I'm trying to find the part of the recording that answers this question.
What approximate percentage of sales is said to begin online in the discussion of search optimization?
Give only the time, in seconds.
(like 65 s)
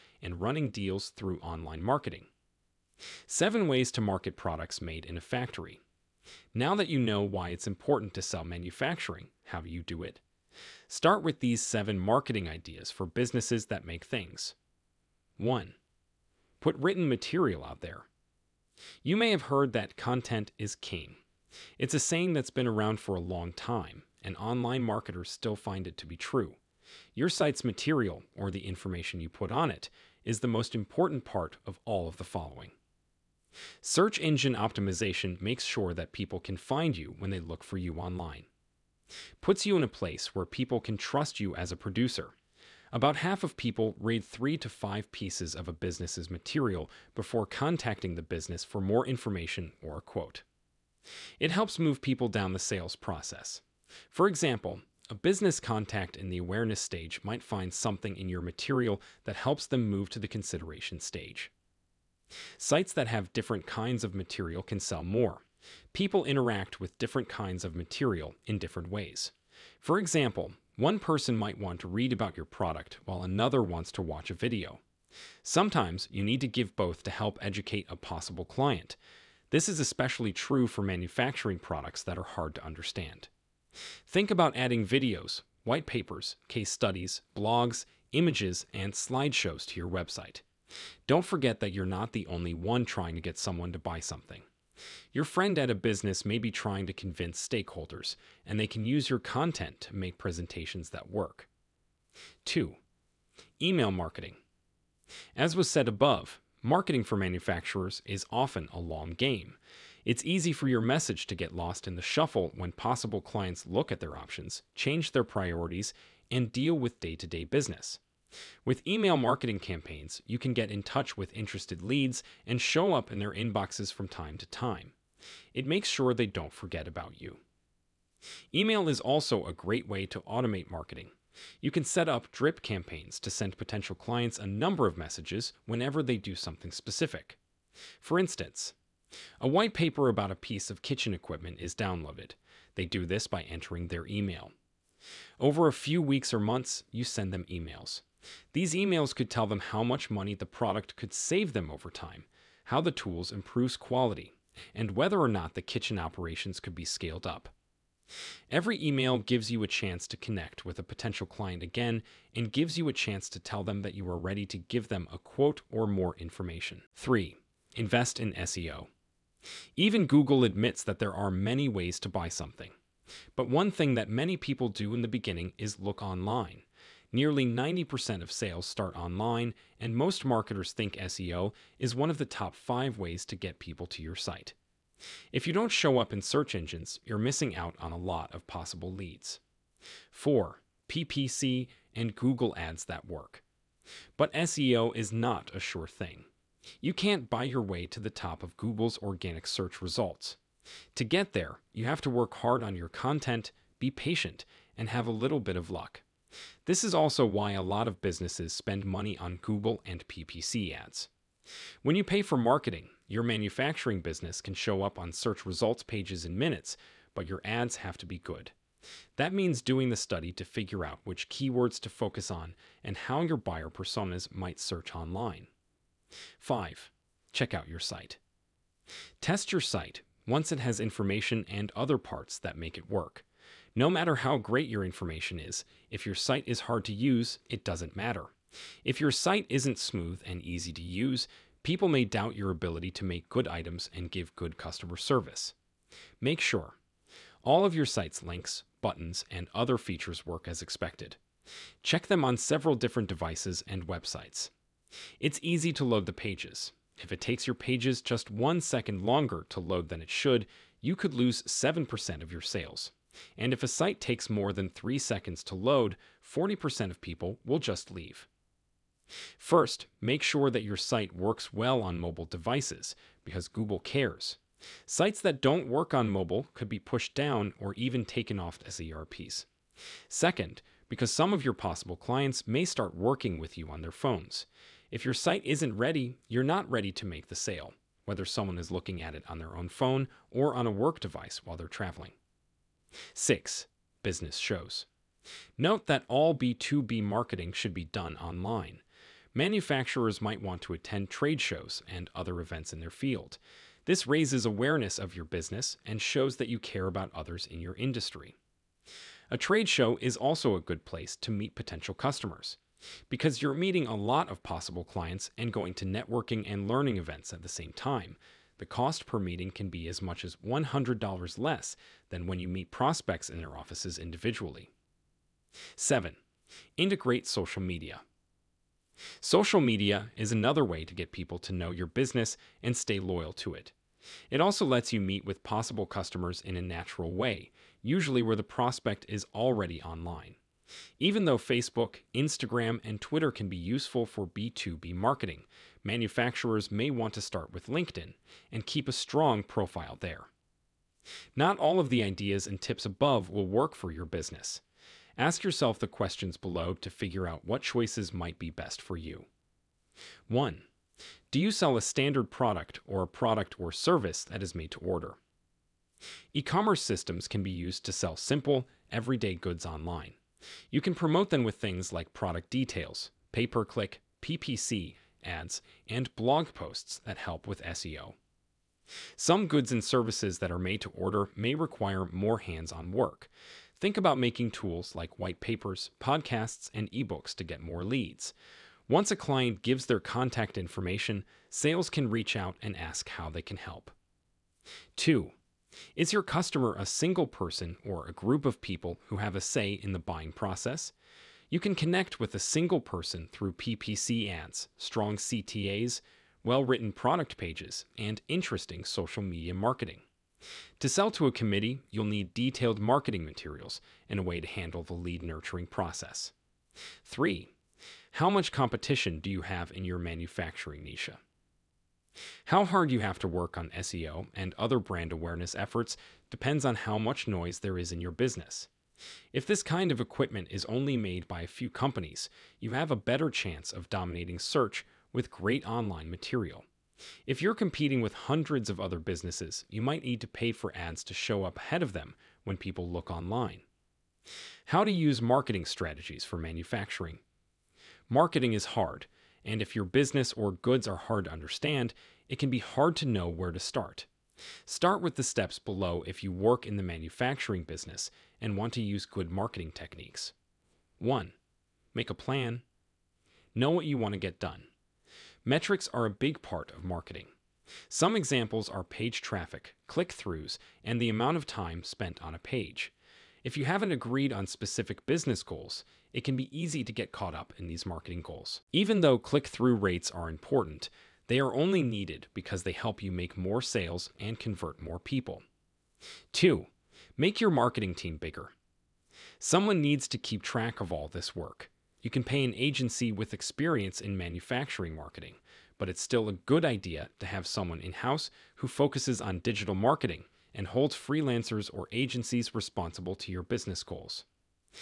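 177 s.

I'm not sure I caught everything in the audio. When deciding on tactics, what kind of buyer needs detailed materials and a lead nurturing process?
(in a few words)
A committee.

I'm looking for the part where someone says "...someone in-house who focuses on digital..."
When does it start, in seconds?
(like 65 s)
497 s.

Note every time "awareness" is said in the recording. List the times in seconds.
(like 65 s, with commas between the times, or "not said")
56 s, 304 s, 425 s.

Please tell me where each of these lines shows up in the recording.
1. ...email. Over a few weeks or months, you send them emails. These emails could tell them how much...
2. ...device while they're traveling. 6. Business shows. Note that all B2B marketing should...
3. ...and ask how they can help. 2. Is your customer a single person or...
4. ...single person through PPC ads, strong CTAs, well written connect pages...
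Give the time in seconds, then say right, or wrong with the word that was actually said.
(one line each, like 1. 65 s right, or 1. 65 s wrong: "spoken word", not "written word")
1. 144 s right
2. 290 s right
3. 392 s right
4. 402 s wrong: "product", not "connect".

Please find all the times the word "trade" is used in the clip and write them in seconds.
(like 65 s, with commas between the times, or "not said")
301 s, 309 s.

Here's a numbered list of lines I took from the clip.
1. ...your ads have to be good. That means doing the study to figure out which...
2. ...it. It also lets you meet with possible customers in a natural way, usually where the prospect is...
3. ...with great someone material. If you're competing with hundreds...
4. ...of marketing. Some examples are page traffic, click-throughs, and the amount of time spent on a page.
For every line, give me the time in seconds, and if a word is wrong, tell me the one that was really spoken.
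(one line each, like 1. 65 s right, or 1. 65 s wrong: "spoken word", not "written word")
1. 217 s right
2. 333 s right
3. 435 s wrong: "online", not "someone"
4. 466 s right.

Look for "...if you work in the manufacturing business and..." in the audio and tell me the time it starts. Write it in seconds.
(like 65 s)
456 s.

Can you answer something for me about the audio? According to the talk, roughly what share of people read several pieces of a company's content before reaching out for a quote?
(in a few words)
About half.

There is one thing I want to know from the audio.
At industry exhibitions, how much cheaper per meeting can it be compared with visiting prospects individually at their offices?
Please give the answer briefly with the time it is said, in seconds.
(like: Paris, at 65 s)
$100, at 320 s.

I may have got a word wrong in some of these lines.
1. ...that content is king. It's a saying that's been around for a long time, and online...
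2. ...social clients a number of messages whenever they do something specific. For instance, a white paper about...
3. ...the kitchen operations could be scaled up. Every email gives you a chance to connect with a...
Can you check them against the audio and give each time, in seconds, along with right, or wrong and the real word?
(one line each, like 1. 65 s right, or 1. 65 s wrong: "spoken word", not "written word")
1. 19 s right
2. 133 s wrong: "potential", not "social"
3. 155 s right.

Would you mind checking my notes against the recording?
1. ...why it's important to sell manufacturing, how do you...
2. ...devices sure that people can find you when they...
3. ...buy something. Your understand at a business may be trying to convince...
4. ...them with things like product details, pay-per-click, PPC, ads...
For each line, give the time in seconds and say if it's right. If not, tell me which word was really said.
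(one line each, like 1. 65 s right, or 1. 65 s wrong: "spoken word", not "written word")
1. 7 s right
2. 35 s wrong: "makes", not "devices"
3. 93 s wrong: "friend", not "understand"
4. 371 s right.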